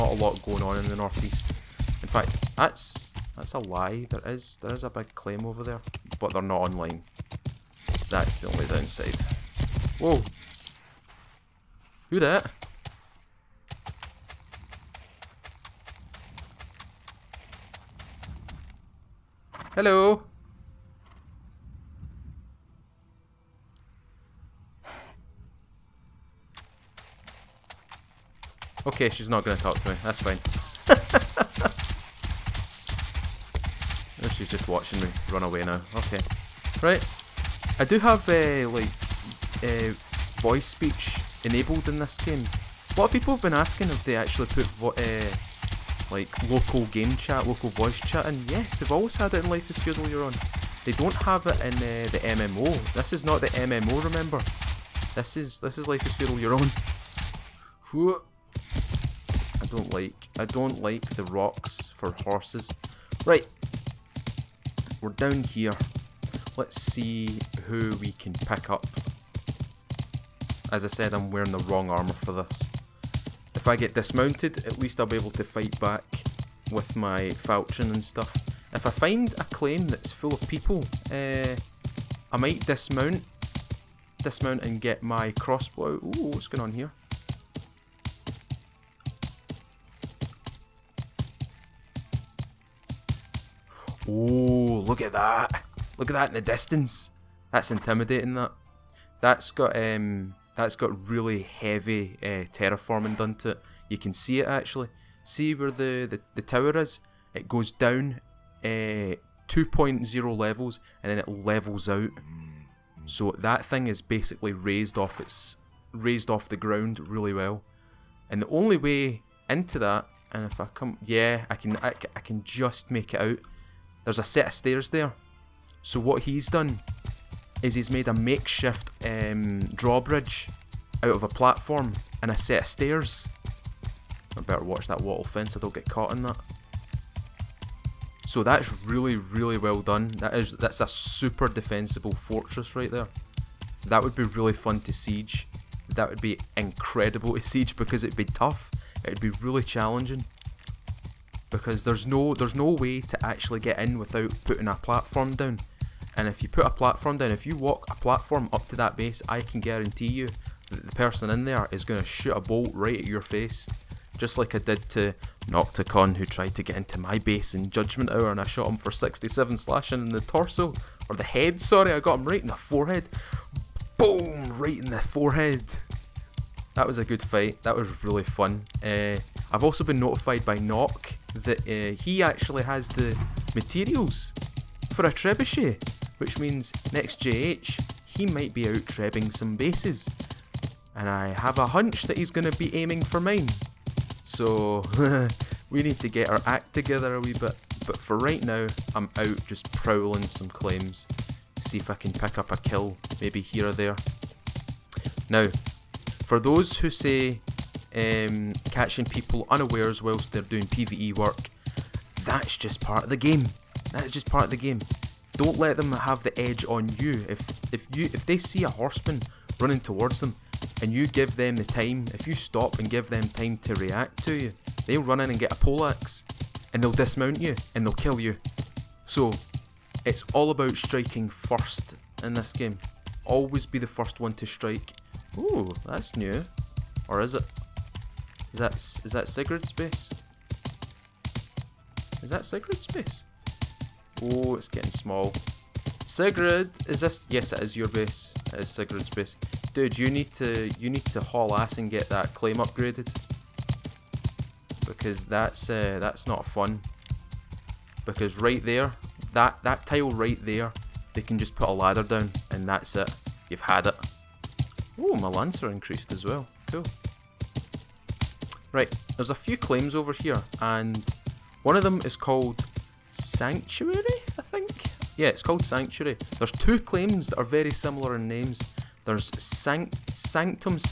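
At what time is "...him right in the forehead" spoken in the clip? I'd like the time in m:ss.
2:52.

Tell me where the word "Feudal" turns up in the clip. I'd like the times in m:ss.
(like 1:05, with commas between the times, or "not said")
0:49, 0:56.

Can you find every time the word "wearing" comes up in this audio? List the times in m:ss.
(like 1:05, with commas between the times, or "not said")
1:11.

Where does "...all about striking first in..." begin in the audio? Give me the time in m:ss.
3:50.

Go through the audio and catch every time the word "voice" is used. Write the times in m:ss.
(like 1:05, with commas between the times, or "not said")
0:40, 0:47.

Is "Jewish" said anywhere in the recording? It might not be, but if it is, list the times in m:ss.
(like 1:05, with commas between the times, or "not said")
not said.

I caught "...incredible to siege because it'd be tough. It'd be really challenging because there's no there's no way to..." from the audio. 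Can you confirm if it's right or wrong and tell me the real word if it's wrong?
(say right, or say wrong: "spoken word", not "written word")
right.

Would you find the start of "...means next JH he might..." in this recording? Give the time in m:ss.
3:06.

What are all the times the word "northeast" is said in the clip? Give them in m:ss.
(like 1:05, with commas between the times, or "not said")
0:00.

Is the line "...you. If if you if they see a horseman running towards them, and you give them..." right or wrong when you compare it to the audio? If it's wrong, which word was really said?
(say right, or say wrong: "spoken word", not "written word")
right.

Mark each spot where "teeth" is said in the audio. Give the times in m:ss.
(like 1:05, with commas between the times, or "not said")
not said.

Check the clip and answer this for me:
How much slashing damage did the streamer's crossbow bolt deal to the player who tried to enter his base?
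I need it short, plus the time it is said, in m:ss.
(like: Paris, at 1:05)
67, at 2:48.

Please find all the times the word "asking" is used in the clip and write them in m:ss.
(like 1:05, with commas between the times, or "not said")
0:43.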